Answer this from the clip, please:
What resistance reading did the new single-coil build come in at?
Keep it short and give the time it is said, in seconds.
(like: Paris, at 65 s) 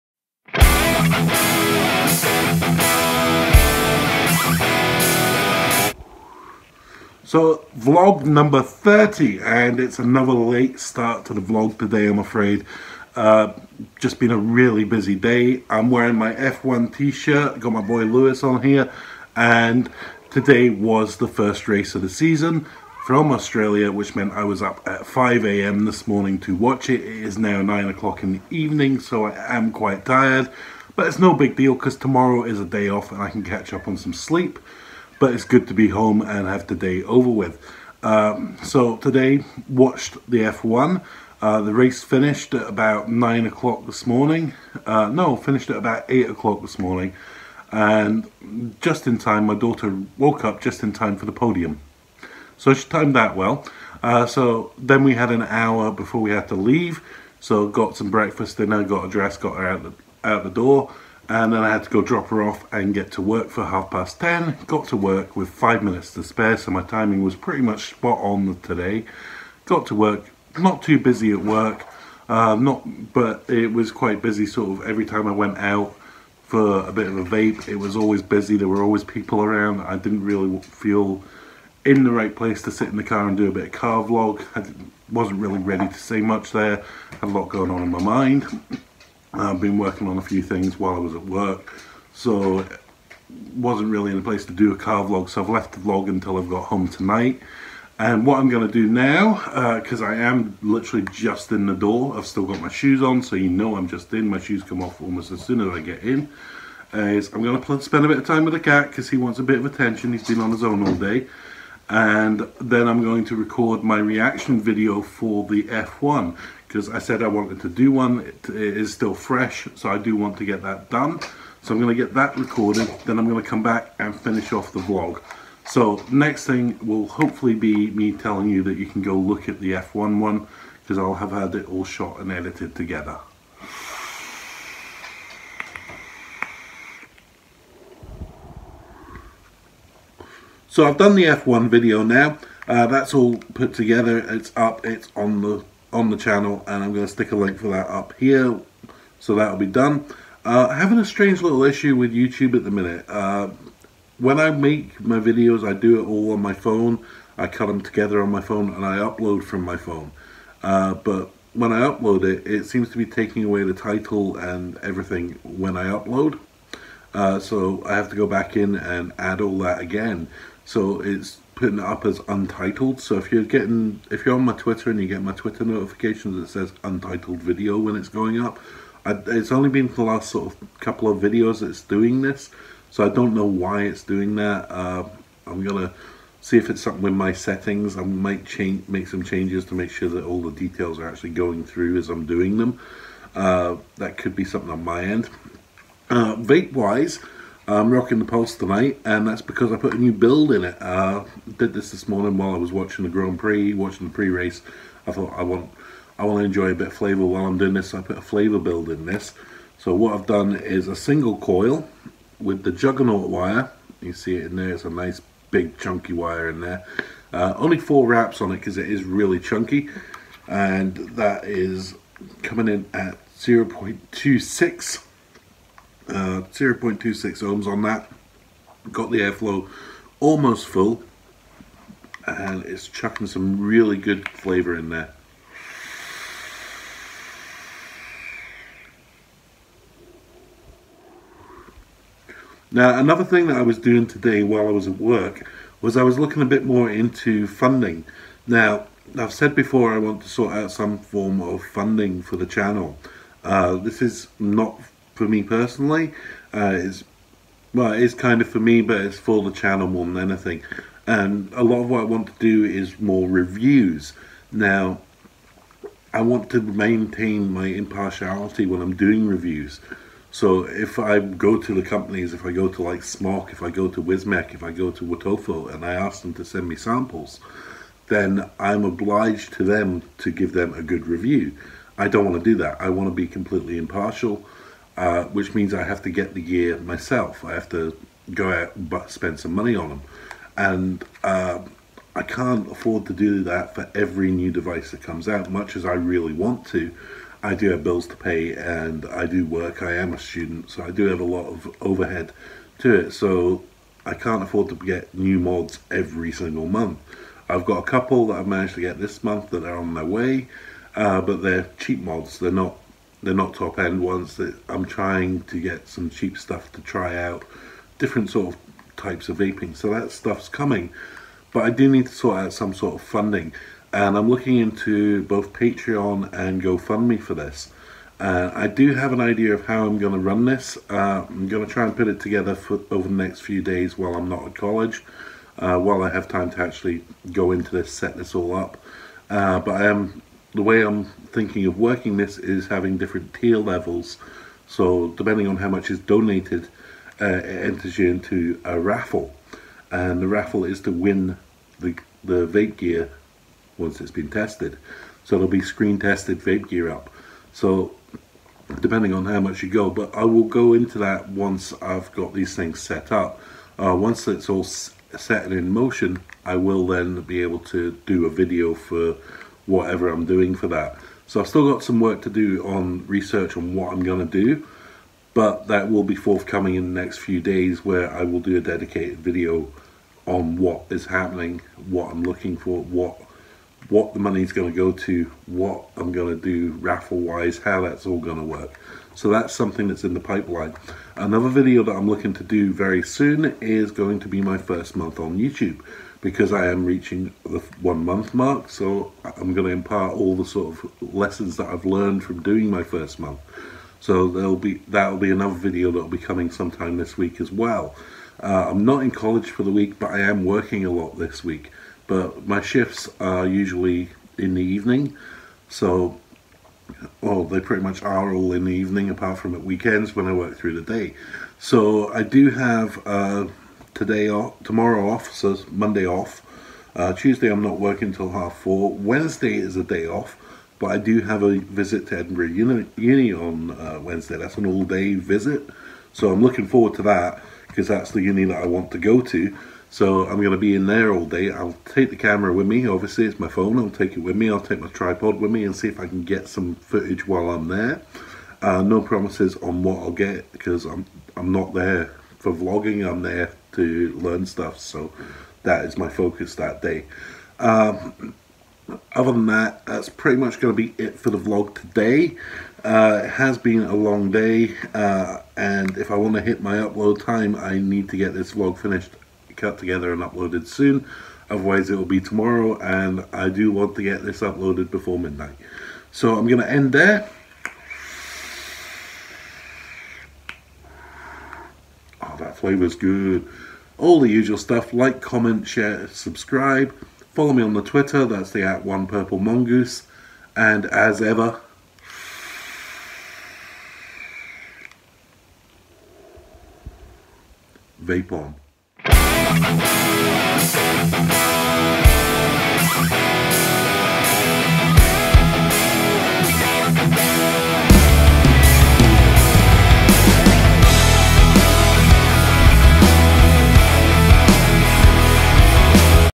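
0.26 ohms, at 226 s.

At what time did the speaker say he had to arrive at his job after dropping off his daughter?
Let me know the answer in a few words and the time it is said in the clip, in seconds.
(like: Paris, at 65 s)
half past 10, at 63 s.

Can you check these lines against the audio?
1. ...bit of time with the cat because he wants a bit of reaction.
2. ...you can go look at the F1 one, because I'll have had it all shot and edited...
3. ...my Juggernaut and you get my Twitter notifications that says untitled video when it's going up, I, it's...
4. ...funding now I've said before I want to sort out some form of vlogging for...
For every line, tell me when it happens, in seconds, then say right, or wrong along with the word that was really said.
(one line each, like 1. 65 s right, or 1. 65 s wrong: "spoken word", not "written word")
1. 108 s wrong: "attention", not "reaction"
2. 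128 s right
3. 174 s wrong: "Twitter", not "Juggernaut"
4. 247 s wrong: "funding", not "vlogging".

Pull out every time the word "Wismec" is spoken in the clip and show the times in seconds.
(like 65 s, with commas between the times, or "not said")
274 s.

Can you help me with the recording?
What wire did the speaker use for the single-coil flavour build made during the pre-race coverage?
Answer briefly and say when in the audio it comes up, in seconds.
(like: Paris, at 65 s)
Juggernaut, at 212 s.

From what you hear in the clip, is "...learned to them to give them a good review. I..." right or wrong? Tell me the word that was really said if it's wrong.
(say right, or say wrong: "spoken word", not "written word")
wrong: "obliged", not "learned".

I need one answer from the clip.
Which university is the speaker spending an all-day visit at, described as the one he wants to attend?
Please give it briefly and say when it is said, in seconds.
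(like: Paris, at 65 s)
Edinburgh Uni, at 432 s.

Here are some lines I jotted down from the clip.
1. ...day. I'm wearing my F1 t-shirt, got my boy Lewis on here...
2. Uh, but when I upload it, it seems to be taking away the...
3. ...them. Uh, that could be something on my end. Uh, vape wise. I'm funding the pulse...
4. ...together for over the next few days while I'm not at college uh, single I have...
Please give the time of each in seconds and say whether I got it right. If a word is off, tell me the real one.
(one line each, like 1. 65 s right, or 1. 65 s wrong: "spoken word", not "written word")
1. 15 s right
2. 160 s right
3. 192 s wrong: "rocking", not "funding"
4. 332 s wrong: "while", not "single".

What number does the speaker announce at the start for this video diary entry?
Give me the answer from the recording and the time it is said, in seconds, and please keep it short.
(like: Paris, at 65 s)
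30, at 8 s.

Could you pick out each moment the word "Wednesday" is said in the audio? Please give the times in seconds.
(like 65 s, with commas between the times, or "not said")
428 s, 434 s.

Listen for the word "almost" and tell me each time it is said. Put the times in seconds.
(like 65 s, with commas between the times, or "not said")
105 s, 230 s.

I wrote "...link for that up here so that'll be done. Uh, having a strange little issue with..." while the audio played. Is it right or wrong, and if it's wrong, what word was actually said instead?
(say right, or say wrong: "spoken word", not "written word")
right.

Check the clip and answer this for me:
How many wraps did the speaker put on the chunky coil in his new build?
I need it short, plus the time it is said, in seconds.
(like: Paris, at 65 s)
4, at 217 s.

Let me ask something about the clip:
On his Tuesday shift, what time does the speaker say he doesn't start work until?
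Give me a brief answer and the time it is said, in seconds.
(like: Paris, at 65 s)
half four, at 428 s.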